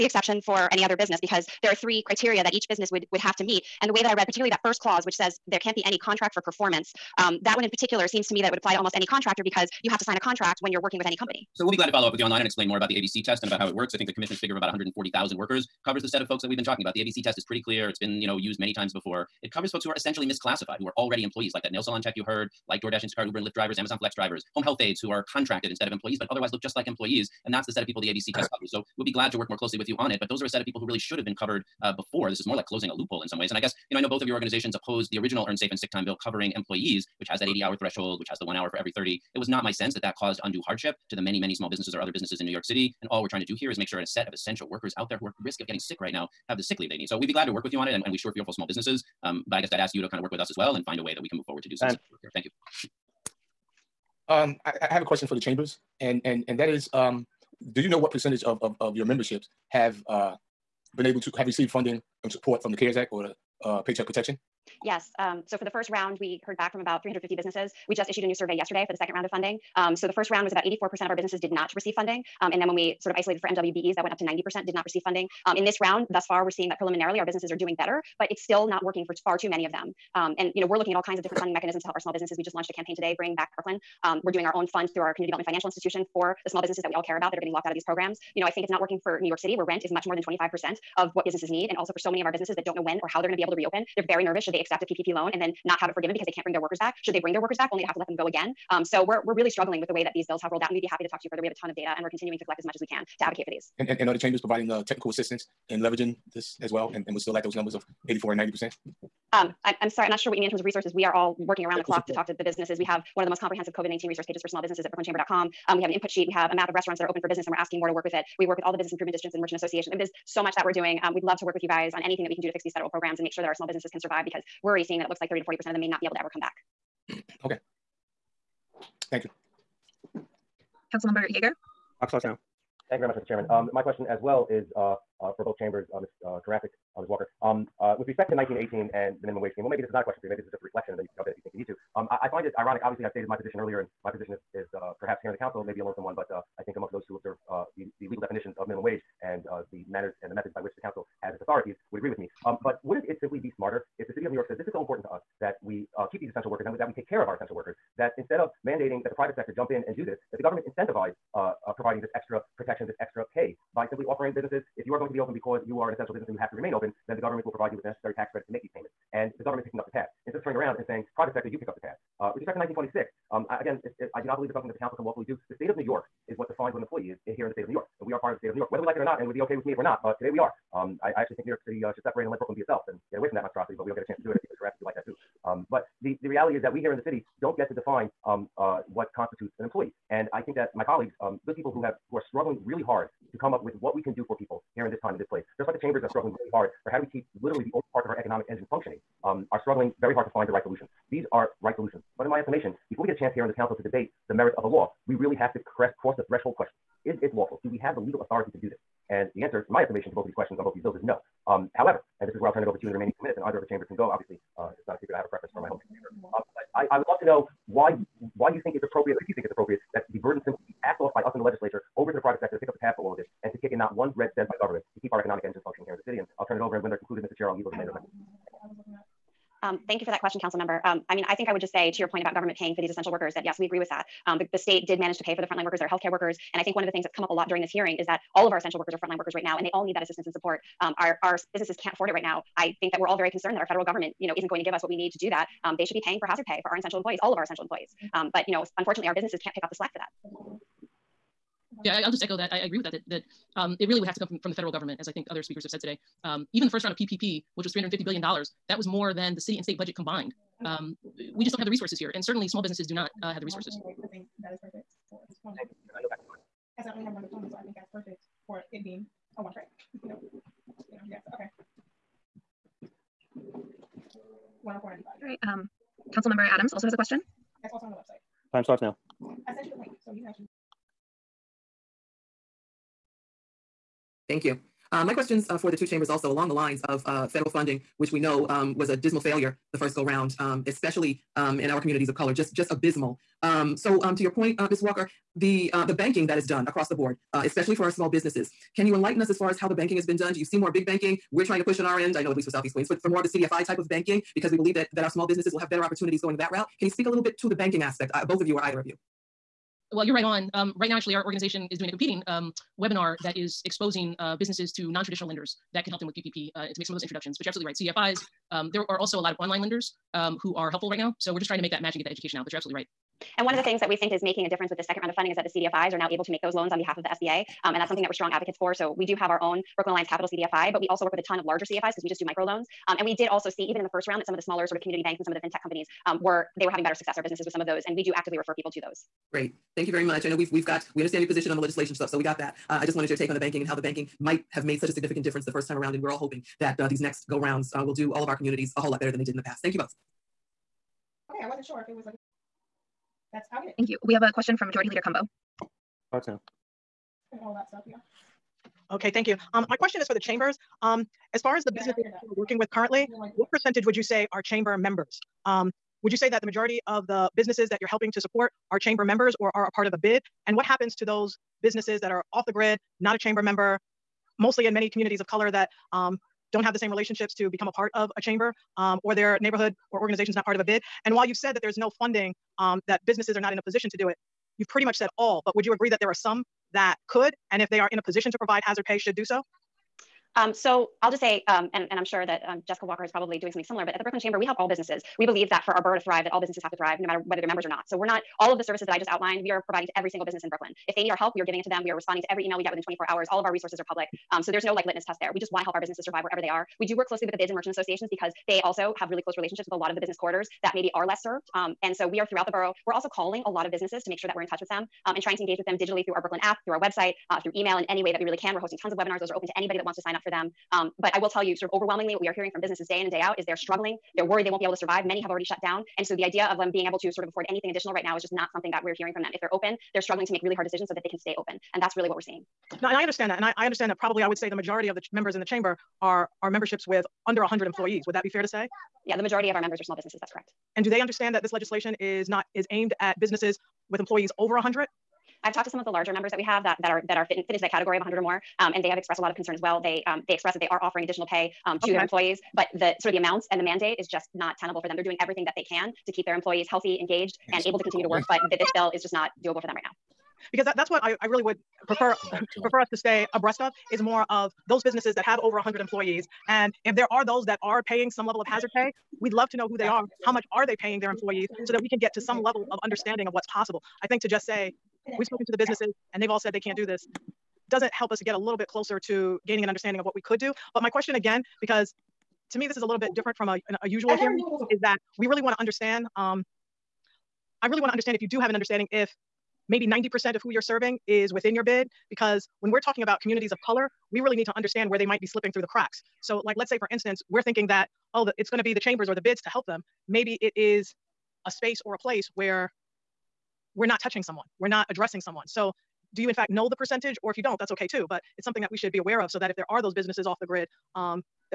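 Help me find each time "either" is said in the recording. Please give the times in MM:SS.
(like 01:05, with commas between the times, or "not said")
03:33, 05:08.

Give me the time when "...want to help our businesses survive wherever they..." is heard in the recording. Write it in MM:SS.
06:45.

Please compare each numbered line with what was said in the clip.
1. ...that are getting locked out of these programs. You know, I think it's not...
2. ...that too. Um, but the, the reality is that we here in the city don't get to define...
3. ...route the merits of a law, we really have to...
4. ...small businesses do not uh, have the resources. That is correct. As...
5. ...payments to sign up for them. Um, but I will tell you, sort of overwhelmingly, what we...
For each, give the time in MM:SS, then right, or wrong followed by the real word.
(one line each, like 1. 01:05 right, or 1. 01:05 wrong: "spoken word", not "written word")
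1. 01:27 right
2. 03:04 right
3. 03:23 wrong: "debate", not "route"
4. 04:22 wrong: "perfect", not "correct"
5. 06:59 wrong: "wants", not "payments".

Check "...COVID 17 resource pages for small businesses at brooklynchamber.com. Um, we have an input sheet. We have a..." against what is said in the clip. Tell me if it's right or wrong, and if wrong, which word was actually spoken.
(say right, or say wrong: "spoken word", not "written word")
wrong: "19", not "17".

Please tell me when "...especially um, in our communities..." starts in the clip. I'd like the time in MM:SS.
04:50.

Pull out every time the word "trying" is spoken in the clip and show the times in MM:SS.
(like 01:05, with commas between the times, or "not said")
00:43, 05:01, 05:21, 06:55.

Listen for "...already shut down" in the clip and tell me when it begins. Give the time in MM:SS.
07:05.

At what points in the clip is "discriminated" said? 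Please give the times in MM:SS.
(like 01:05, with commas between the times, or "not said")
not said.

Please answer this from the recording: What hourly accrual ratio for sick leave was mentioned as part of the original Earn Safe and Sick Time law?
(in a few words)
one hour for every 30.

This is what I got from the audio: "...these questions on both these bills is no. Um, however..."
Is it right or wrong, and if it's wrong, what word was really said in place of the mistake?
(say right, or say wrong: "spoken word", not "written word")
right.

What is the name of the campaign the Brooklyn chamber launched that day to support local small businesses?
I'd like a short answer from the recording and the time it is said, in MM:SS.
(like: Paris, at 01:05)
Bring Back Brooklyn, at 01:23.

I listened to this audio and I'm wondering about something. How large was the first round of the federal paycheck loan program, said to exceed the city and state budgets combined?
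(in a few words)
$350 billion.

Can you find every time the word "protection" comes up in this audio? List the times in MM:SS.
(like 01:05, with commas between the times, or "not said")
01:04, 02:42.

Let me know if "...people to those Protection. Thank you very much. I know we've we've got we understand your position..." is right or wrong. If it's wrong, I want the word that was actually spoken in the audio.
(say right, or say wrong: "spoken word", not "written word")
wrong: "Great", not "Protection".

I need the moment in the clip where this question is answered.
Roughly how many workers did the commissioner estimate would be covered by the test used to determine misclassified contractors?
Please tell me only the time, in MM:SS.
00:14.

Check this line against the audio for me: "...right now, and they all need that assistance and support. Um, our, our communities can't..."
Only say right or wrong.
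wrong.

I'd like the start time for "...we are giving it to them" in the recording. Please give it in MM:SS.
06:41.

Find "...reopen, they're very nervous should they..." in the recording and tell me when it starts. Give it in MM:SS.
01:33.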